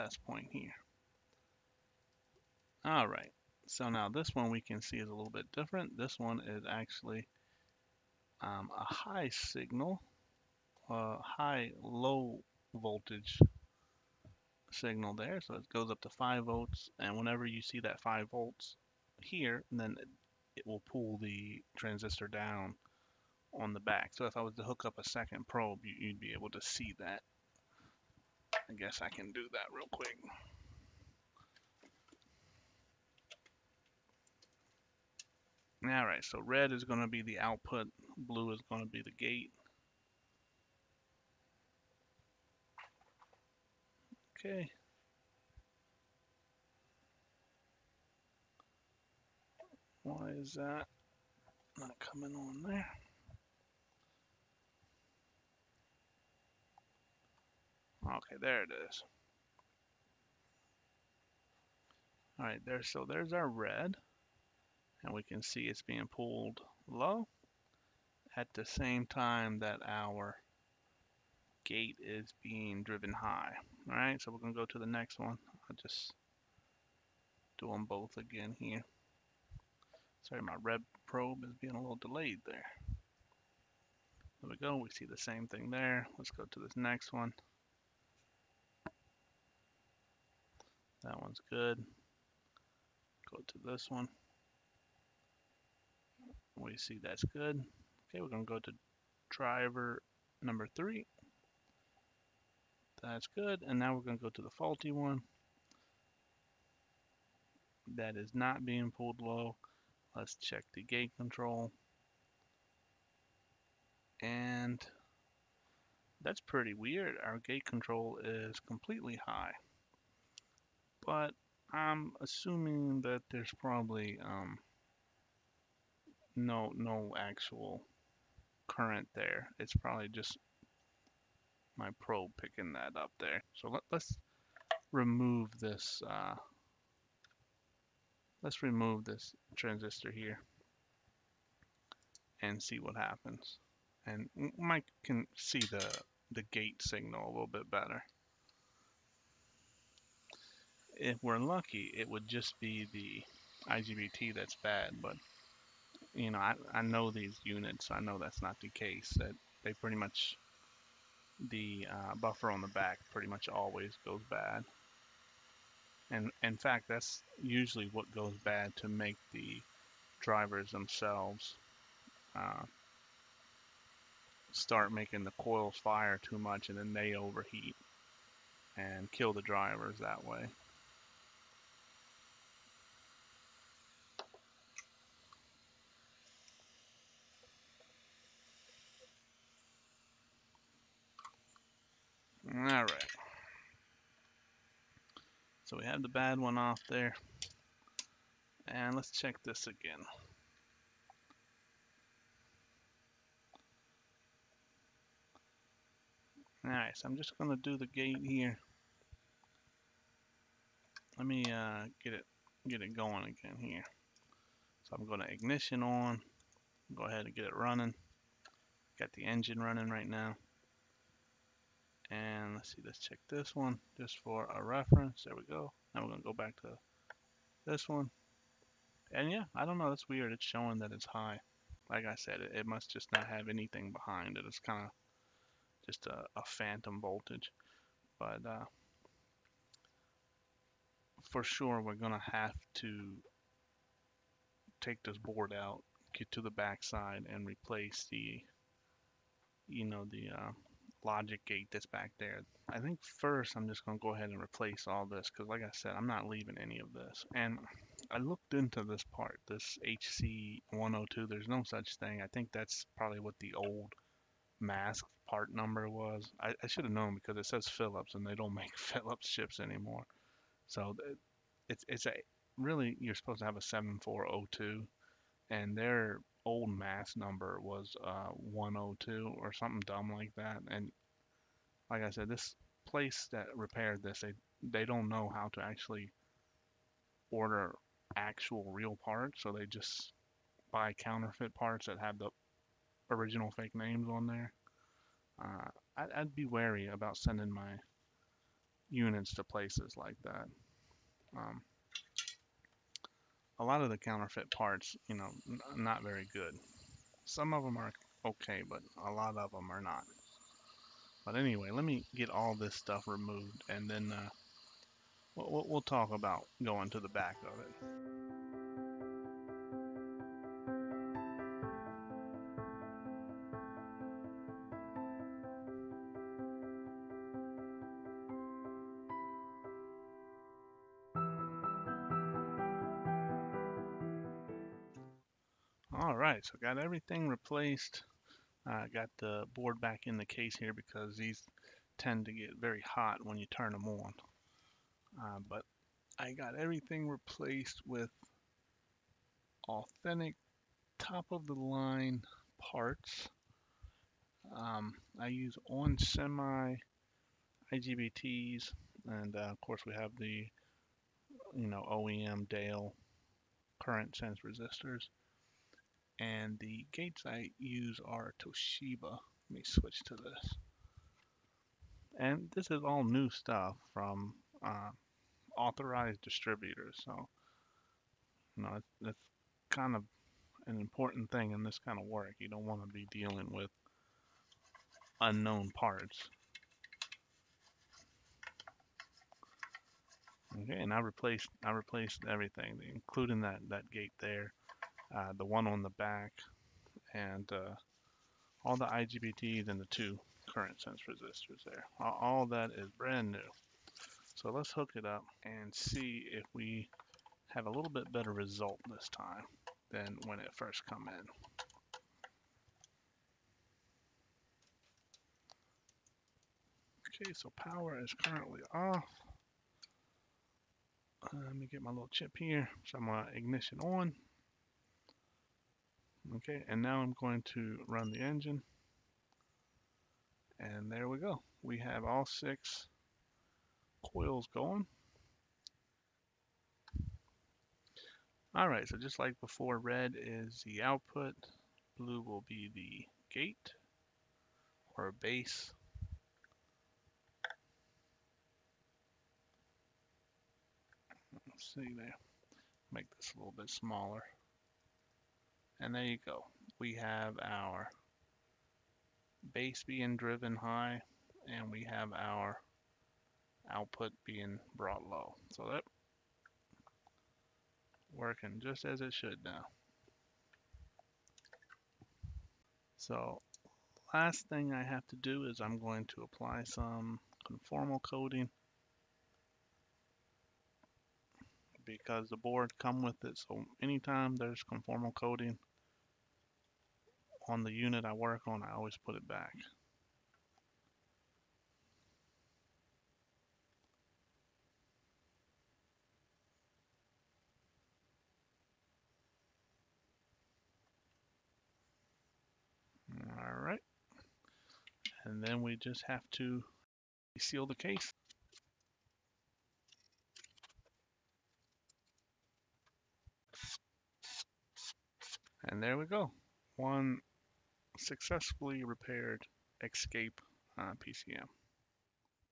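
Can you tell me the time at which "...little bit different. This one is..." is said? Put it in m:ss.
0:05.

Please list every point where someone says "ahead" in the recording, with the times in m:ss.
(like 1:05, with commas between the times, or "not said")
3:37, 4:14.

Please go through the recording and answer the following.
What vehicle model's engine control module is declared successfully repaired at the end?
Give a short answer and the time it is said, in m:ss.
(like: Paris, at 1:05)
Escape, at 8:39.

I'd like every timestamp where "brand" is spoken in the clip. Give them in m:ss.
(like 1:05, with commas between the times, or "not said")
6:42.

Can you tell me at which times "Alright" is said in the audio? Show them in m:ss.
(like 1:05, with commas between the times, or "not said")
0:35, 3:12, 3:26.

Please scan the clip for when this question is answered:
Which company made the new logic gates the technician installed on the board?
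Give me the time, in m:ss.
6:08.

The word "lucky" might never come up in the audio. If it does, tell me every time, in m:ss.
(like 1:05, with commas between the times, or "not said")
2:31.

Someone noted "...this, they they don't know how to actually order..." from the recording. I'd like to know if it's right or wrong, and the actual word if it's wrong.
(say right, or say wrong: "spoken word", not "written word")
right.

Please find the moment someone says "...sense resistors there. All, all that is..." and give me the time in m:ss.
6:40.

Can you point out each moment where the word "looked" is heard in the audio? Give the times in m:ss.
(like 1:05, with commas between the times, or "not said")
4:18.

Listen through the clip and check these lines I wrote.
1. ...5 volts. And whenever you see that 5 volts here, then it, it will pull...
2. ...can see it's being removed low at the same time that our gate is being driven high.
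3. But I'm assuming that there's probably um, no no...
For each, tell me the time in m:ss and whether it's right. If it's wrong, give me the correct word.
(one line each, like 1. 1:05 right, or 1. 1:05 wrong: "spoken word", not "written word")
1. 0:16 right
2. 1:05 wrong: "pulled", not "removed"
3. 2:01 right.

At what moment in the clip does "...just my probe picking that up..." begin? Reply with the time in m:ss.
2:10.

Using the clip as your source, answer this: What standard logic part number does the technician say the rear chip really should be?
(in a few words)
7402.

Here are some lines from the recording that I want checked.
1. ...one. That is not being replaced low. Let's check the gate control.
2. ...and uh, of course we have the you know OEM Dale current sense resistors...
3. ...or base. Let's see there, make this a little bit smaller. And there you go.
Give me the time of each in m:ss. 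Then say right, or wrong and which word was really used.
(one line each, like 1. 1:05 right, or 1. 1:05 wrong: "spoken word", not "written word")
1. 1:44 wrong: "pulled", not "replaced"
2. 5:59 right
3. 7:24 right.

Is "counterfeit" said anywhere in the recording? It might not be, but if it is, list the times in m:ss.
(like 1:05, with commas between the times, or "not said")
4:50, 5:03.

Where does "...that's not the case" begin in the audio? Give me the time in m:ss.
2:38.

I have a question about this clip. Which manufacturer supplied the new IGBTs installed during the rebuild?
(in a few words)
onsemi.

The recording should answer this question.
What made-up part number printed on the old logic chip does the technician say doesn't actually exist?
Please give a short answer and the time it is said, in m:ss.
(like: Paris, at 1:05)
HC102, at 4:19.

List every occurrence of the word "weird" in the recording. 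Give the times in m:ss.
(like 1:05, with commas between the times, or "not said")
1:56, 3:50.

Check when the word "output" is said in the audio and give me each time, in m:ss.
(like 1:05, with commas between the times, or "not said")
0:37, 7:20, 7:43.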